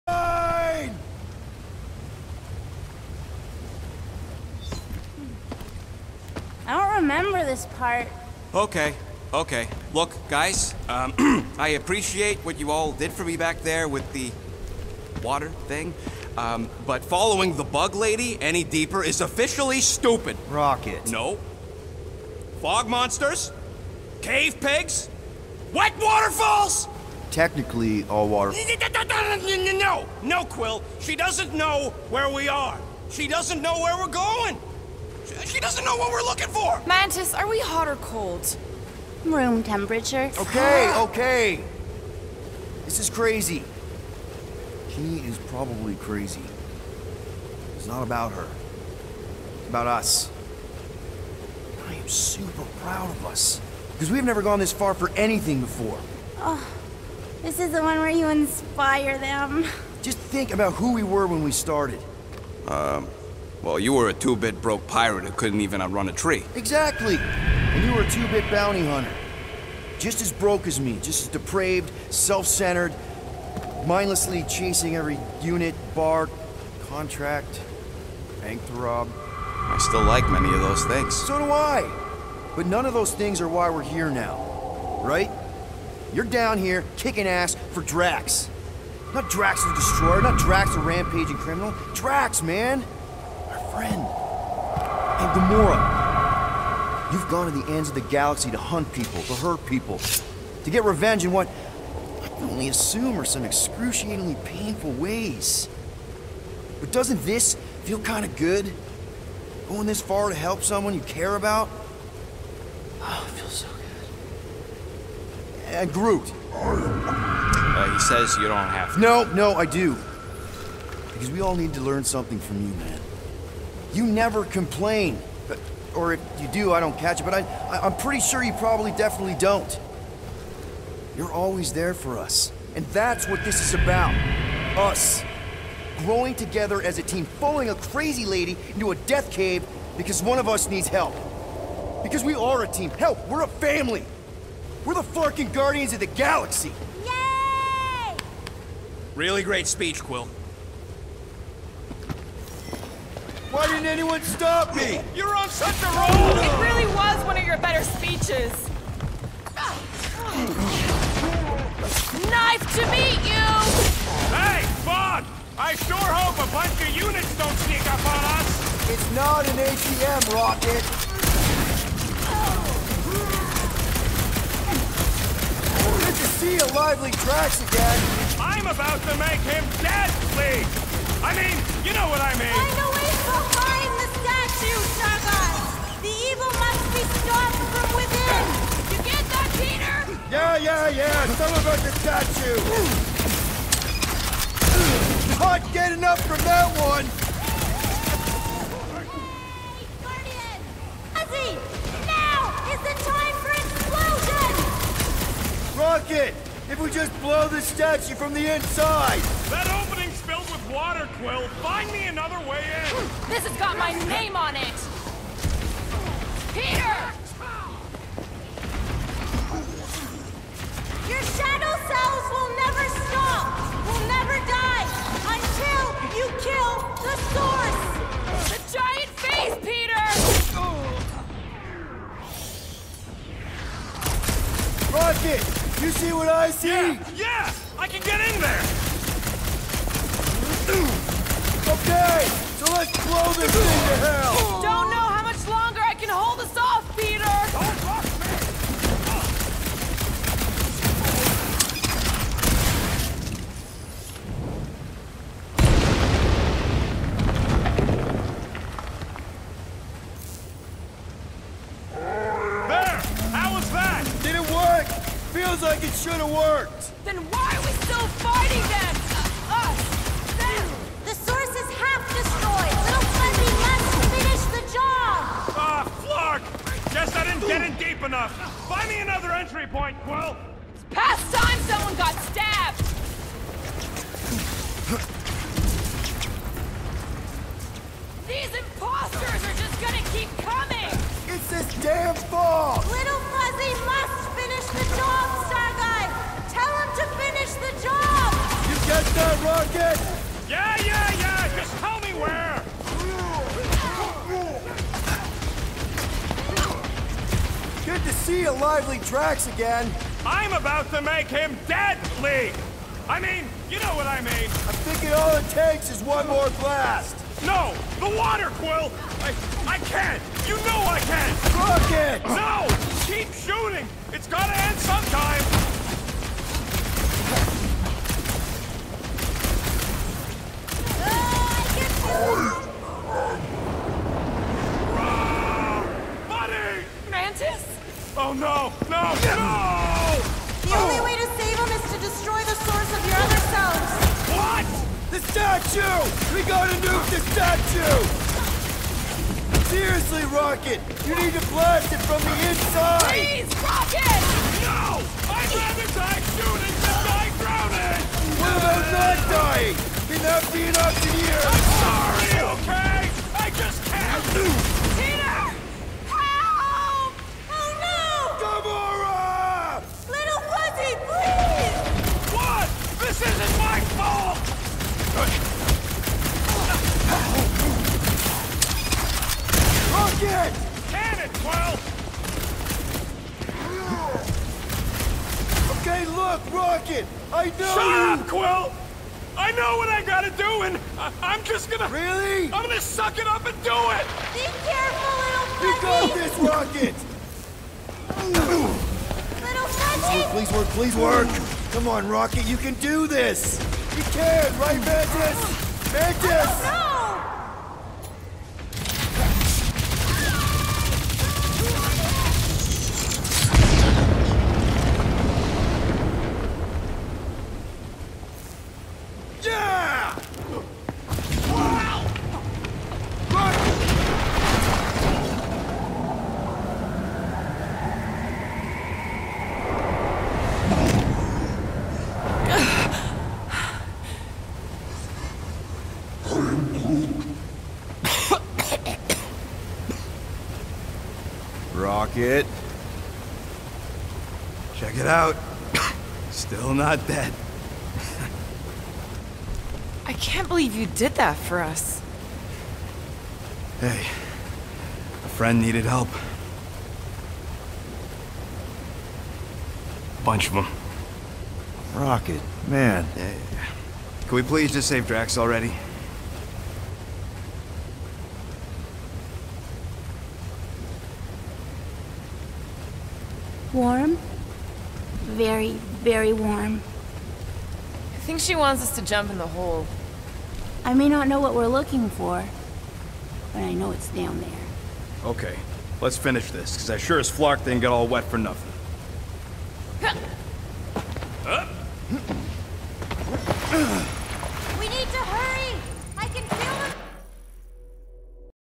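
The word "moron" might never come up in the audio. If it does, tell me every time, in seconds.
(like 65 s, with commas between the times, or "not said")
95 s.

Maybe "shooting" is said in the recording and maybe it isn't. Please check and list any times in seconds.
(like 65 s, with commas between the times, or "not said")
323 s, 356 s.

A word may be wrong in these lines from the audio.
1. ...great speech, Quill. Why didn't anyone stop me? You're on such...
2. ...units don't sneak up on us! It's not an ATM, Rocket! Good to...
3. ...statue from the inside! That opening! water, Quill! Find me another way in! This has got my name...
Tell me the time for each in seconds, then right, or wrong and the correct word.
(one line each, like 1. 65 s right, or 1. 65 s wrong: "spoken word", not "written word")
1. 149 s right
2. 166 s right
3. 207 s right.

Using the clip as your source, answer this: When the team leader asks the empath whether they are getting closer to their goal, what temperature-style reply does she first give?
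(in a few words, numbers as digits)
Room temperature.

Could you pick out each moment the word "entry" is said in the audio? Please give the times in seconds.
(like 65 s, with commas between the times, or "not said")
279 s.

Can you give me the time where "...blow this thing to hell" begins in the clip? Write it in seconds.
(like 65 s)
243 s.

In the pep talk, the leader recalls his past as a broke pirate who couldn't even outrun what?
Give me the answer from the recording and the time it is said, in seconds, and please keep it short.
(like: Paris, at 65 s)
a tree, at 66 s.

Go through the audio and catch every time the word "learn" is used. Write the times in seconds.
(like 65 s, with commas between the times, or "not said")
121 s.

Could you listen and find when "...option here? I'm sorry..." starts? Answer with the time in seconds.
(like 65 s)
360 s.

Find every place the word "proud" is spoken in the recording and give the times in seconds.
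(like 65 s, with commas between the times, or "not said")
52 s.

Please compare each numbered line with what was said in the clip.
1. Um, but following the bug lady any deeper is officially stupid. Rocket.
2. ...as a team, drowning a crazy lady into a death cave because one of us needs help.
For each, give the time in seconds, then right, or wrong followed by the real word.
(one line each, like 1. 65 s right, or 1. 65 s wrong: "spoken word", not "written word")
1. 16 s right
2. 136 s wrong: "following", not "drowning".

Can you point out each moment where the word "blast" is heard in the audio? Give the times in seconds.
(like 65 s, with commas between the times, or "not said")
316 s, 351 s.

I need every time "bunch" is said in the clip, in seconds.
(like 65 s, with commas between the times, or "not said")
166 s, 460 s.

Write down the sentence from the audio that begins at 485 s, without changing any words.
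Okay, let's finish this, because I sure as Flark didn't get all wet for nothing.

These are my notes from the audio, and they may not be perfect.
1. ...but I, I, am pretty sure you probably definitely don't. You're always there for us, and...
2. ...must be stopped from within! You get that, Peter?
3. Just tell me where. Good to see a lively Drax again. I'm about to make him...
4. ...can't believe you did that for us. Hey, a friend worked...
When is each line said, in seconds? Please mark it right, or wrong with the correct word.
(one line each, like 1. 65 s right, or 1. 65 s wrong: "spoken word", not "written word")
1. 127 s right
2. 186 s right
3. 301 s right
4. 450 s wrong: "needed", not "worked".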